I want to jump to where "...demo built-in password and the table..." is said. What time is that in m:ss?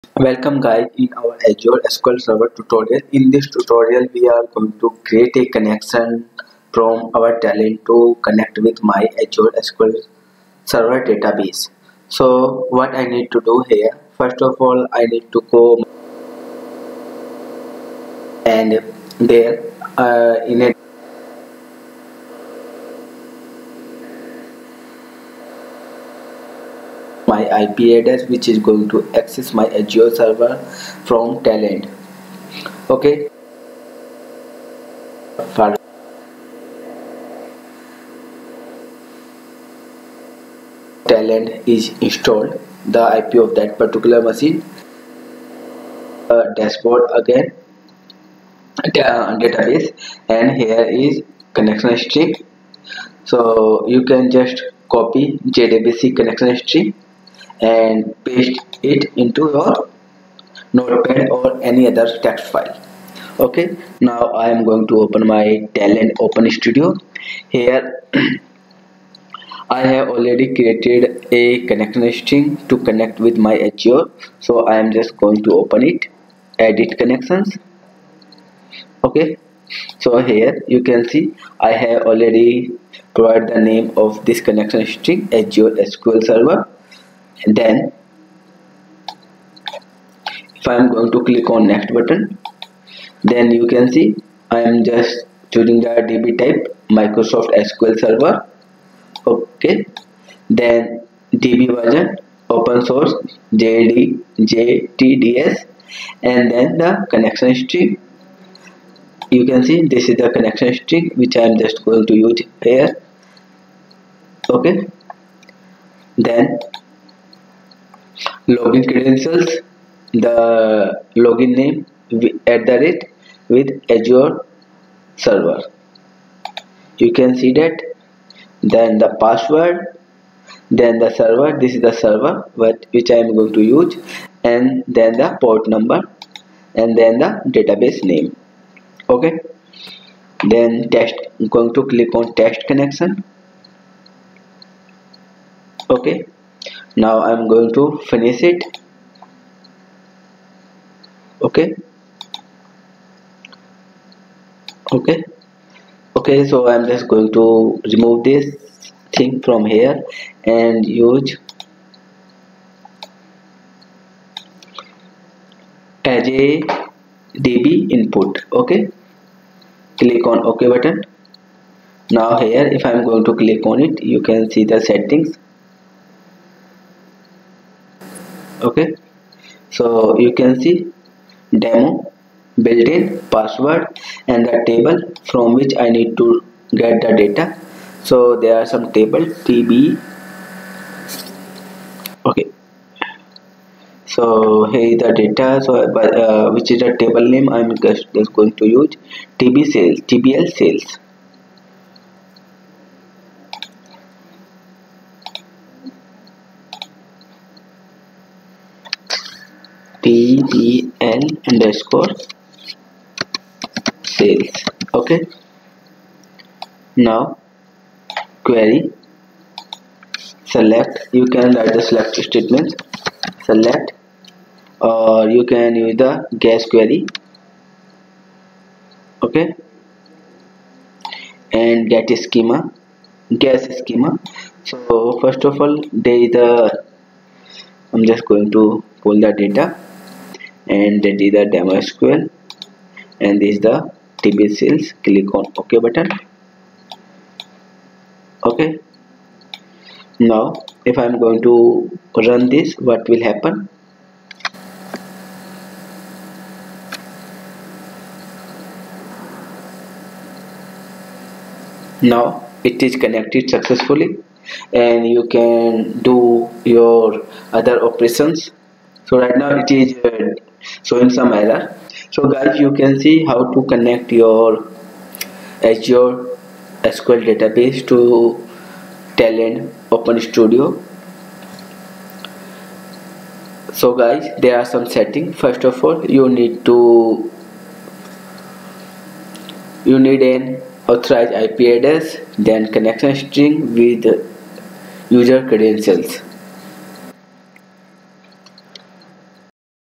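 3:01.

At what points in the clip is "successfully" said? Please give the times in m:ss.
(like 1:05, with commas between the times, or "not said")
4:23.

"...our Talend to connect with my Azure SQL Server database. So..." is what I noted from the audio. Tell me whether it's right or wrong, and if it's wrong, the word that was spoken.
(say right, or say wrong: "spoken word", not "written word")
right.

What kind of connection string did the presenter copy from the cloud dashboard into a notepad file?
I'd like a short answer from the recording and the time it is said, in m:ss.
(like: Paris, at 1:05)
JDBC, at 0:55.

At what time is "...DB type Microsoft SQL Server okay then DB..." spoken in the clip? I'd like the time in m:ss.
1:36.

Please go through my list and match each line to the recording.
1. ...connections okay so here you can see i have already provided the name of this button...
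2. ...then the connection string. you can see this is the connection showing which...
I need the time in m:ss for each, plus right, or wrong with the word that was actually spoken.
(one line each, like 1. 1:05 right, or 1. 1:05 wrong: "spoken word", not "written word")
1. 1:16 wrong: "connection", not "button"
2. 1:46 wrong: "string", not "showing".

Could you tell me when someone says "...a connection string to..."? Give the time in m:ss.
1:11.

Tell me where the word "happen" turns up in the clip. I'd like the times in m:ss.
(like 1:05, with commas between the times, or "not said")
4:13.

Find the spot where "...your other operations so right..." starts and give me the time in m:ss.
4:26.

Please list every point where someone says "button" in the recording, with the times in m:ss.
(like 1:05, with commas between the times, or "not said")
1:31, 2:50, 4:05.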